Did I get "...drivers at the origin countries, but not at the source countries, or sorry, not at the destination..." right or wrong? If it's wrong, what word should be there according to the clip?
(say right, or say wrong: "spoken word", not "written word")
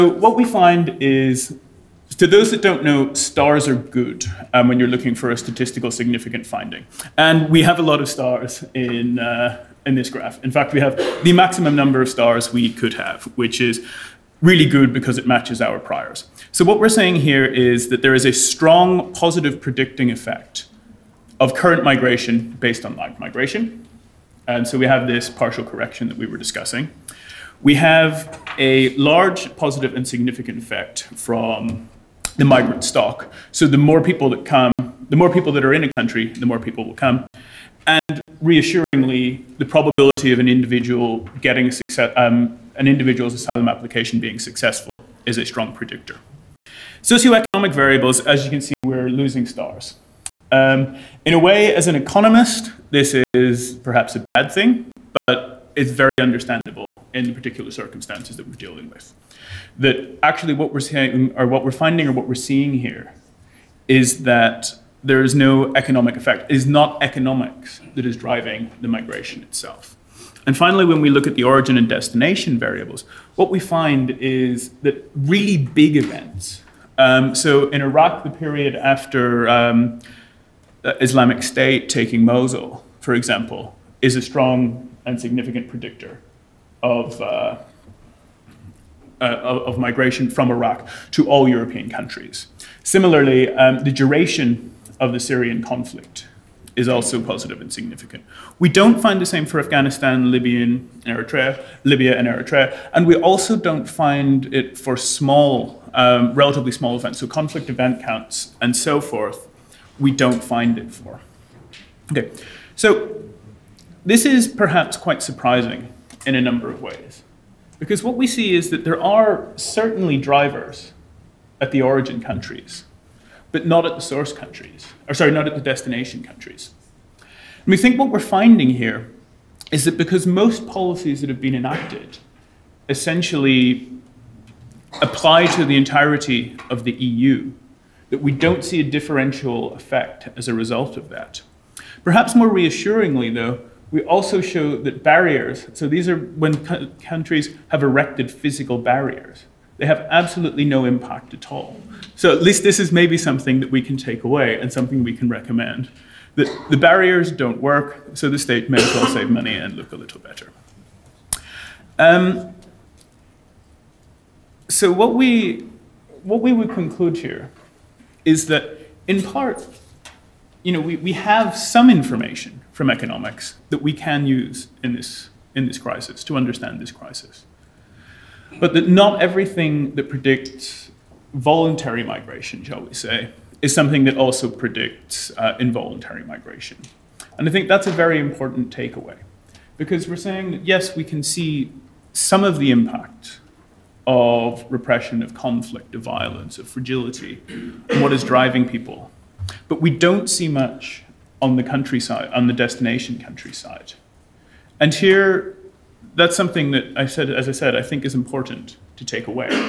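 right.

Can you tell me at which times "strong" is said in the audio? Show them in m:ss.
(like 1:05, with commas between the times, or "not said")
0:18, 0:45, 1:24.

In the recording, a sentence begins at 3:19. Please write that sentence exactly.
But we don't see much on the countryside, on the destination countryside.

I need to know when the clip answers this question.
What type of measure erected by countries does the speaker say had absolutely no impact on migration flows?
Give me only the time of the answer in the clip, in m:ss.
2:28.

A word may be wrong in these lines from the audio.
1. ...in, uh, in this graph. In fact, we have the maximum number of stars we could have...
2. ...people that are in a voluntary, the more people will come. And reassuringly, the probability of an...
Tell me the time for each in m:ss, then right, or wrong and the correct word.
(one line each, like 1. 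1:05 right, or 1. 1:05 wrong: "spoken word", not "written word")
1. 0:08 right
2. 0:35 wrong: "country", not "voluntary".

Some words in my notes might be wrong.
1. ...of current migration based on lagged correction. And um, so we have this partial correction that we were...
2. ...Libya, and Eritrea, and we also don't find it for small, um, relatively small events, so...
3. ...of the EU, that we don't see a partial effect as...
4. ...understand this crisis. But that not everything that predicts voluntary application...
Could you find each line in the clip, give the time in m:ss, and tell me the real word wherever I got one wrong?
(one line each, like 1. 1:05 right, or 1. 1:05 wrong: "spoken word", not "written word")
1. 0:21 wrong: "migration", not "correction"
2. 1:41 right
3. 2:16 wrong: "differential", not "partial"
4. 2:56 wrong: "migration", not "application".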